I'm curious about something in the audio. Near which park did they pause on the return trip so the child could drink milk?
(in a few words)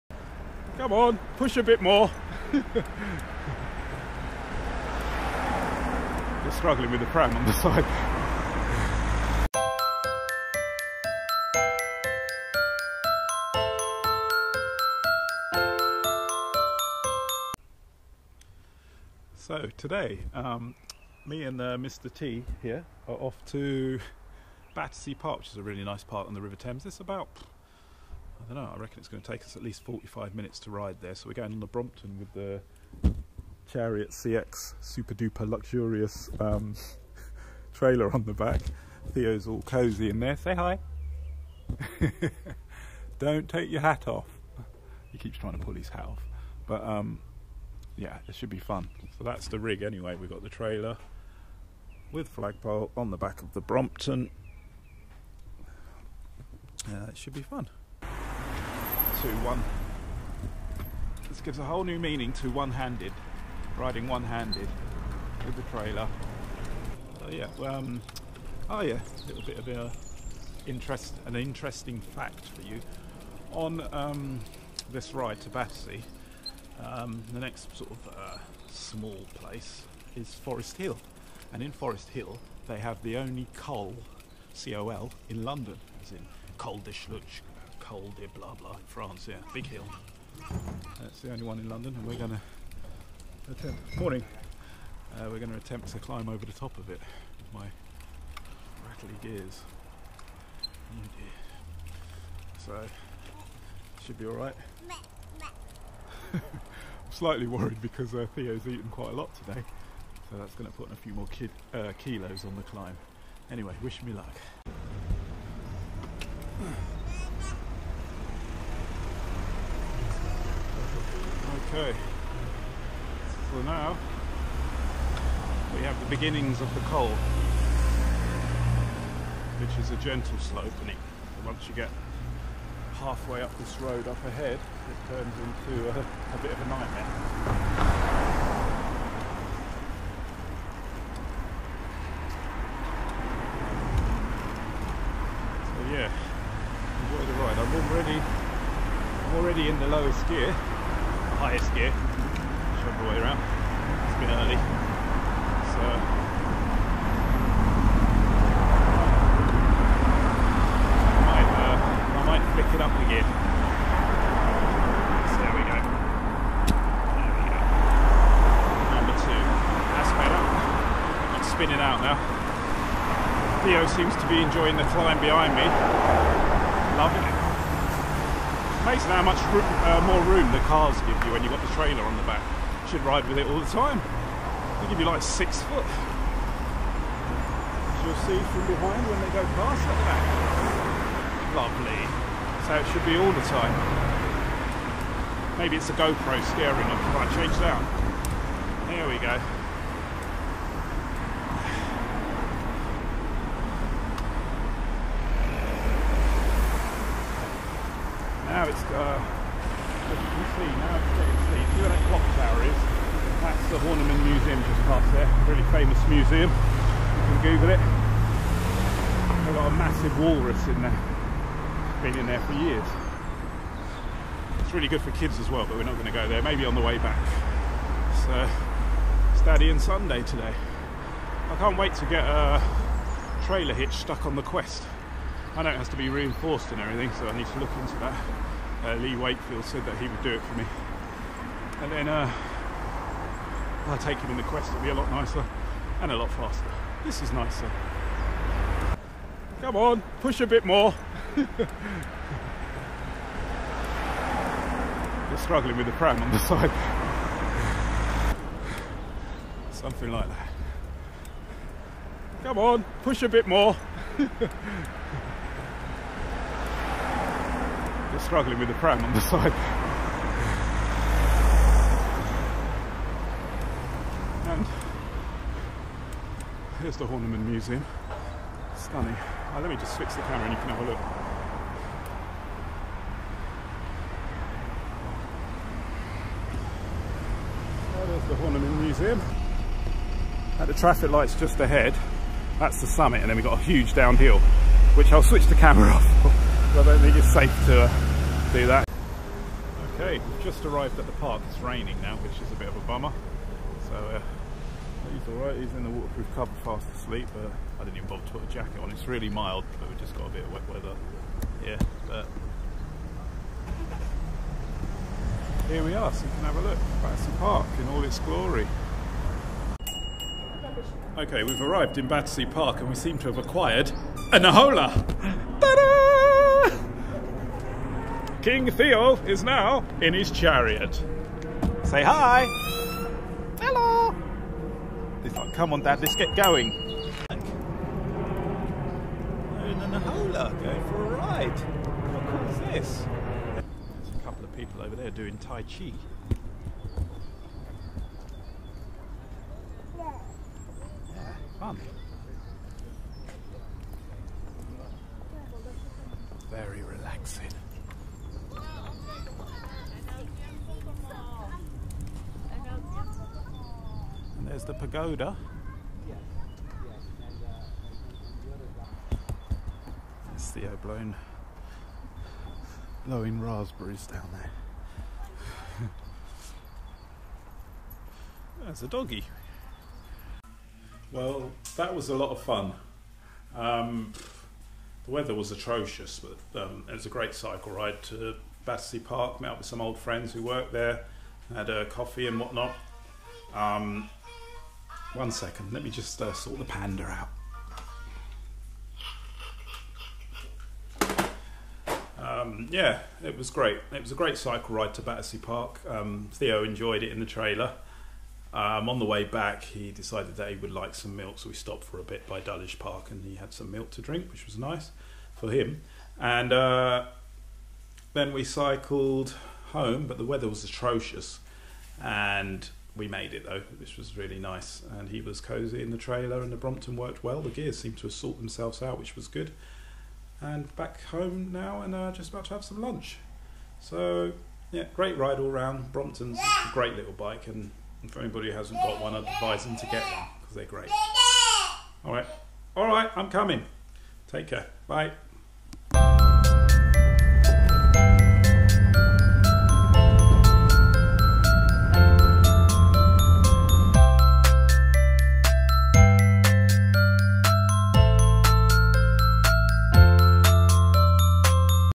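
Dulwich Park.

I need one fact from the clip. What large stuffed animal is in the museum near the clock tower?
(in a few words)
walrus.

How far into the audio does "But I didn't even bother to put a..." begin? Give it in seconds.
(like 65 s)
307 s.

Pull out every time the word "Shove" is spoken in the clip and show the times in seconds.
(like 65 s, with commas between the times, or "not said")
151 s.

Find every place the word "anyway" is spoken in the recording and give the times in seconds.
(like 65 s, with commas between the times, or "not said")
49 s, 113 s.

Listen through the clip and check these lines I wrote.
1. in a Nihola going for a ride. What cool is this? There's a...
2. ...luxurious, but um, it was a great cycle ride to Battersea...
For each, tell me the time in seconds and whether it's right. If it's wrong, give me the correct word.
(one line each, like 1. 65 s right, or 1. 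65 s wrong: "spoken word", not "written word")
1. 337 s right
2. 385 s wrong: "atrocious", not "luxurious".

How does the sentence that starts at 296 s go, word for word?
I don't think it's safe to uh, do that.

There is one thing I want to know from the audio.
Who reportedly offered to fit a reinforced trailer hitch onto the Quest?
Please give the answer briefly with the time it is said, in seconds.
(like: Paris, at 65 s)
Lee Wakefield, at 238 s.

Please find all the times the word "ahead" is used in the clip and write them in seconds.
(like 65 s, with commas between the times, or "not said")
134 s, 291 s.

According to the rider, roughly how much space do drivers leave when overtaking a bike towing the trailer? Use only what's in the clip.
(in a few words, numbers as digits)
six foot.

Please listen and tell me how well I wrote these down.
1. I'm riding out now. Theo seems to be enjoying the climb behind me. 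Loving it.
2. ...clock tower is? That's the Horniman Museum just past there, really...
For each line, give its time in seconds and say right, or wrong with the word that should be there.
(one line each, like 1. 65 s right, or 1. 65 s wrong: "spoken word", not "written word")
1. 170 s wrong: "spinning", not "riding"
2. 212 s right.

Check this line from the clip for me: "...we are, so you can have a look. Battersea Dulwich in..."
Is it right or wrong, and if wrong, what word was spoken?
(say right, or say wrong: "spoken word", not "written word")
wrong: "Park", not "Dulwich".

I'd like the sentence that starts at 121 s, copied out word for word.
So now we have the beginnings of the col, which is a gentle slope.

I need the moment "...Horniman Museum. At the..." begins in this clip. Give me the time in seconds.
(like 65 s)
288 s.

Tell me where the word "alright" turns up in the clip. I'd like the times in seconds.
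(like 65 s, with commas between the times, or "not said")
104 s, 305 s.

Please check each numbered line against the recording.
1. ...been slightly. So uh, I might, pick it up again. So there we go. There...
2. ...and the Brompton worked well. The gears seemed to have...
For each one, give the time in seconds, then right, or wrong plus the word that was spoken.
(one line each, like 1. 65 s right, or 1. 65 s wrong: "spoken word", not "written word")
1. 154 s wrong: "early", not "slightly"
2. 426 s right.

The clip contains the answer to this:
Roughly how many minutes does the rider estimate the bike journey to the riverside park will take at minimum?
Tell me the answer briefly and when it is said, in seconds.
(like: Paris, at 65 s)
45 minutes, at 29 s.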